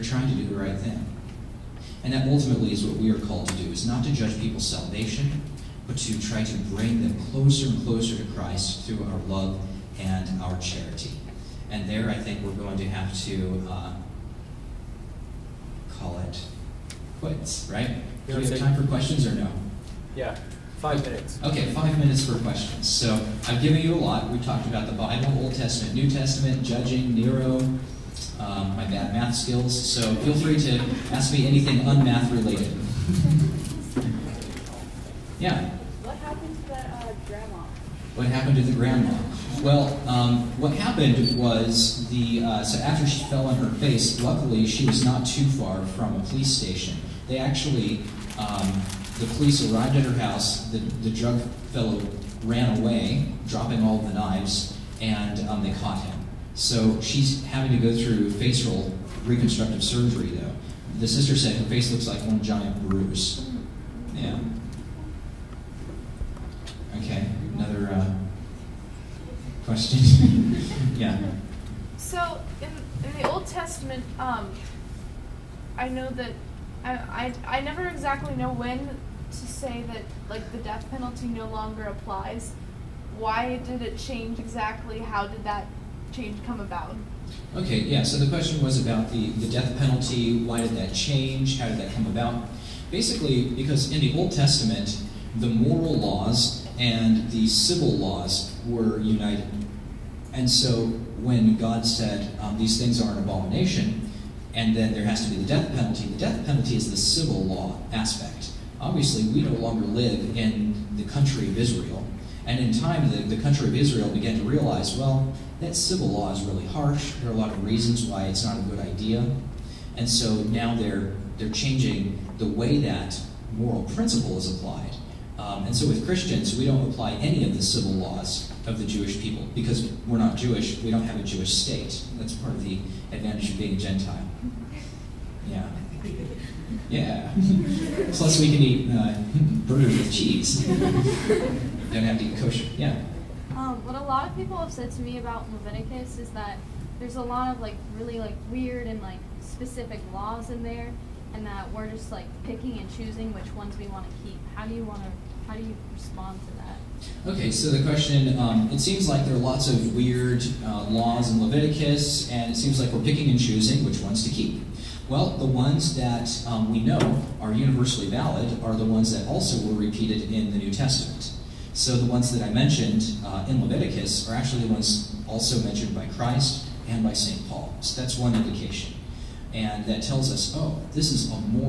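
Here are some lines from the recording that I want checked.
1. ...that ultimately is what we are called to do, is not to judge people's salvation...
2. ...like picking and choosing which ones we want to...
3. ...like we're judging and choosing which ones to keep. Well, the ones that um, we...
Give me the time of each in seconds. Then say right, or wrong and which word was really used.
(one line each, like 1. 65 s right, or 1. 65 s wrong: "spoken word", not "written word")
1. 2 s right
2. 152 s right
3. 162 s wrong: "picking", not "judging".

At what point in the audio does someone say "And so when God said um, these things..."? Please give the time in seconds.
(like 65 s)
100 s.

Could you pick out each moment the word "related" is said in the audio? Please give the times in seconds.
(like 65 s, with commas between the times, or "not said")
32 s.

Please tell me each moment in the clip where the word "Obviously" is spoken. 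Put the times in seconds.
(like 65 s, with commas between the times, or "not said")
108 s.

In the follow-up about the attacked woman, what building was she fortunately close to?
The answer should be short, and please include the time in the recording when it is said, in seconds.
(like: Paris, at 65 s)
a police station, at 46 s.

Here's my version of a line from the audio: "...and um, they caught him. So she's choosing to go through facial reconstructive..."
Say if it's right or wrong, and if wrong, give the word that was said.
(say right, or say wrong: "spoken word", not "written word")
wrong: "having", not "choosing".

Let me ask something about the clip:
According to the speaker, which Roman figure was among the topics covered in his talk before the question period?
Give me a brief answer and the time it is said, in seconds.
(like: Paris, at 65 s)
Nero, at 27 s.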